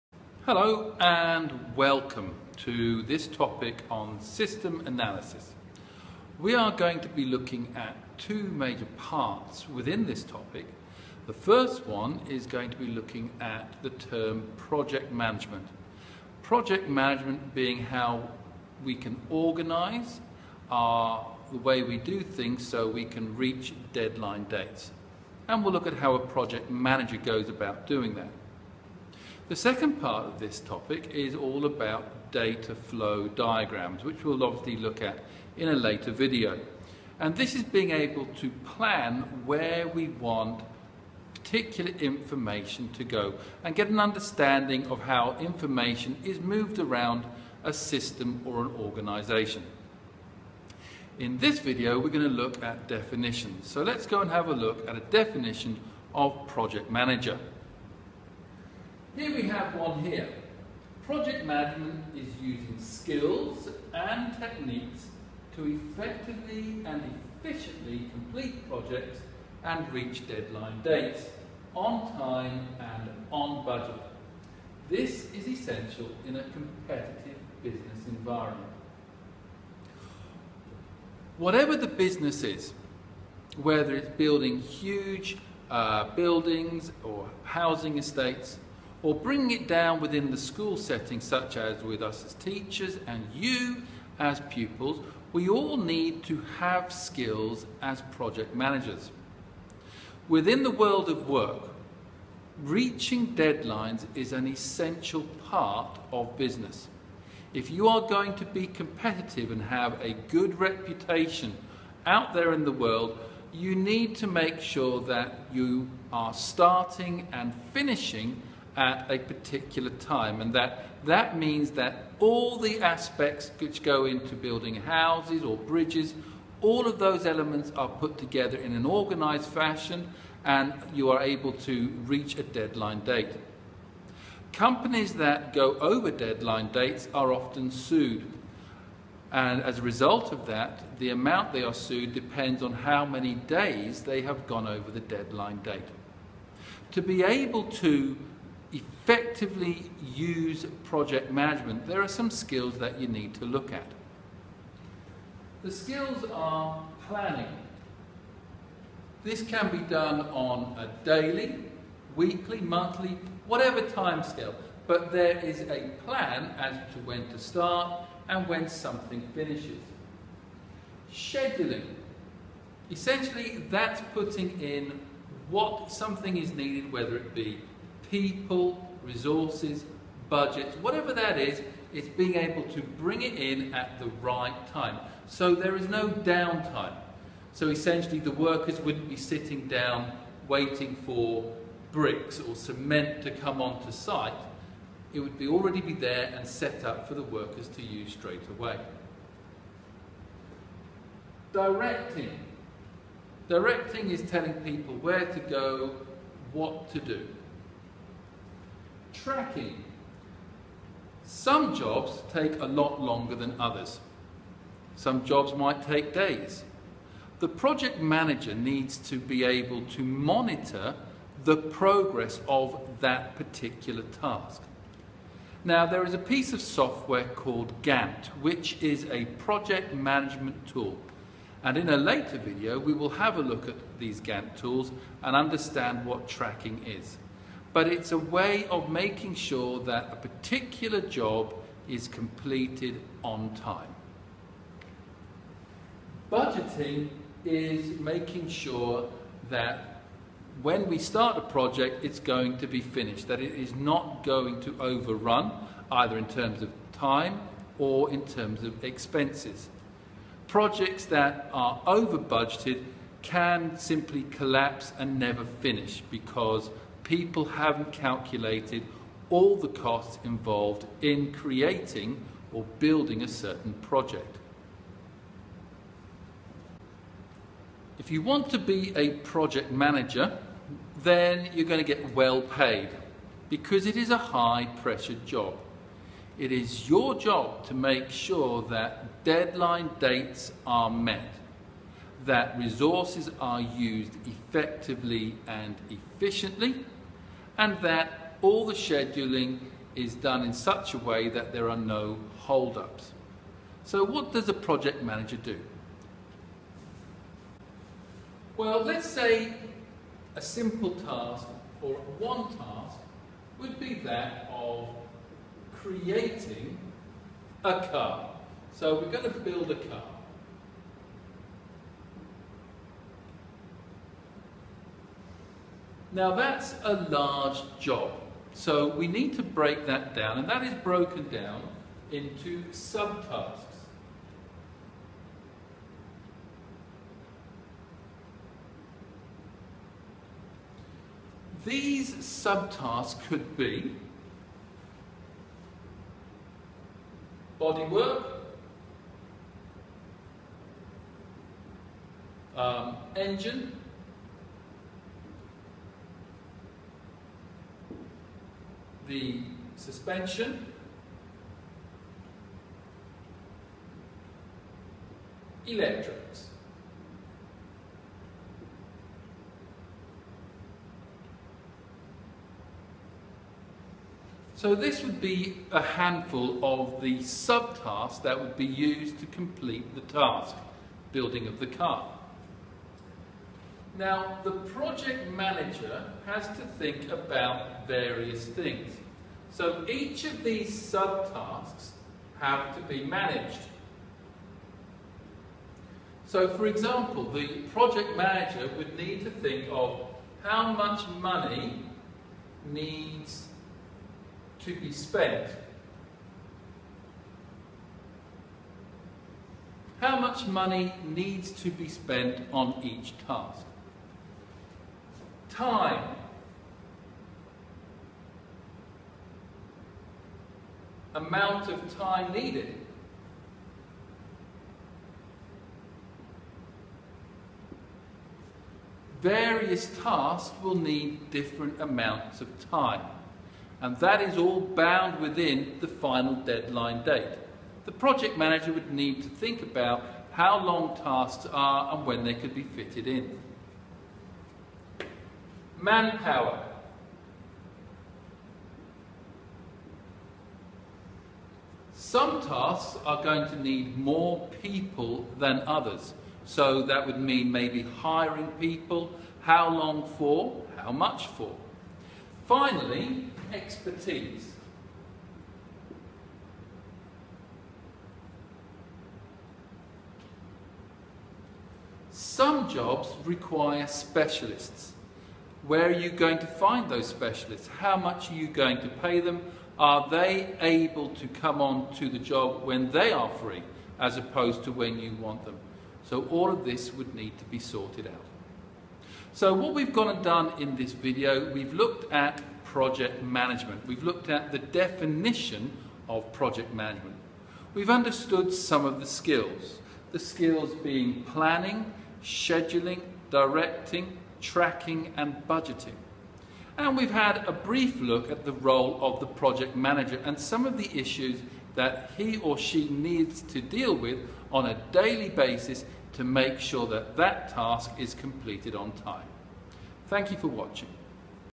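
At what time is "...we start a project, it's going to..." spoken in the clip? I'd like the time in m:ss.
4:10.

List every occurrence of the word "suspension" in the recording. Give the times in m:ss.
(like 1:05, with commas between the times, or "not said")
5:59.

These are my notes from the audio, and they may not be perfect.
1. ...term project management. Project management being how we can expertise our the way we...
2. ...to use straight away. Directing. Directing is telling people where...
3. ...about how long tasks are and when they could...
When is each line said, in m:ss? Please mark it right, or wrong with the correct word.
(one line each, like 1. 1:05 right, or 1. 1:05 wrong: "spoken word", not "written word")
1. 0:13 wrong: "organise", not "expertise"
2. 3:17 right
3. 7:19 right.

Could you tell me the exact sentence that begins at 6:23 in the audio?
Now, the project manager has to think about various things.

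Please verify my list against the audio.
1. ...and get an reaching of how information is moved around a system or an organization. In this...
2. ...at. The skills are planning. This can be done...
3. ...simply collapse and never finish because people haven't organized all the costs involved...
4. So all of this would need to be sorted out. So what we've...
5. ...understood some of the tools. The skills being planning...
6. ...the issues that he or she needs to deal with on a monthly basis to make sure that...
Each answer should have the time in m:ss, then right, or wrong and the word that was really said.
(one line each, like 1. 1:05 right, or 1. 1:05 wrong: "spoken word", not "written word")
1. 0:43 wrong: "understanding", not "reaching"
2. 2:33 right
3. 4:23 wrong: "calculated", not "organized"
4. 8:06 right
5. 8:17 wrong: "skills", not "tools"
6. 8:30 wrong: "daily", not "monthly".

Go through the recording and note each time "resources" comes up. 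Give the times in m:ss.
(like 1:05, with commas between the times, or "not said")
2:59, 4:52.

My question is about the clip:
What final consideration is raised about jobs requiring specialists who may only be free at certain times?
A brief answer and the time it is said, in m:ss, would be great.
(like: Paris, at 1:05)
Expertise, at 7:43.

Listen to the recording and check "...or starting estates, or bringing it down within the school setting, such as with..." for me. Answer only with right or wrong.
wrong.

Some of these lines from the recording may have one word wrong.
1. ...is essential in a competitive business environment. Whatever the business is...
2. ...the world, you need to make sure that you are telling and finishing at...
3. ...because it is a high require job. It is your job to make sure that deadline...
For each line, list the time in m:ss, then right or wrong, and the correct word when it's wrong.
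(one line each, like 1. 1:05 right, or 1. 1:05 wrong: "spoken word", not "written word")
1. 1:15 right
2. 1:52 wrong: "starting", not "telling"
3. 4:43 wrong: "pressure", not "require".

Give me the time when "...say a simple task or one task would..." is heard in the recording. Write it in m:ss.
5:09.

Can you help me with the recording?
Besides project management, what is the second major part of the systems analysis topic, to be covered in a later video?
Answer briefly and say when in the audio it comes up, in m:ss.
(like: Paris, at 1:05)
Data flow diagrams, at 0:32.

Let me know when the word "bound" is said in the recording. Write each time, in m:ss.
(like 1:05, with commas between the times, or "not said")
7:14.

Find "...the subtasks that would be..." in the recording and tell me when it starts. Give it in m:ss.
6:17.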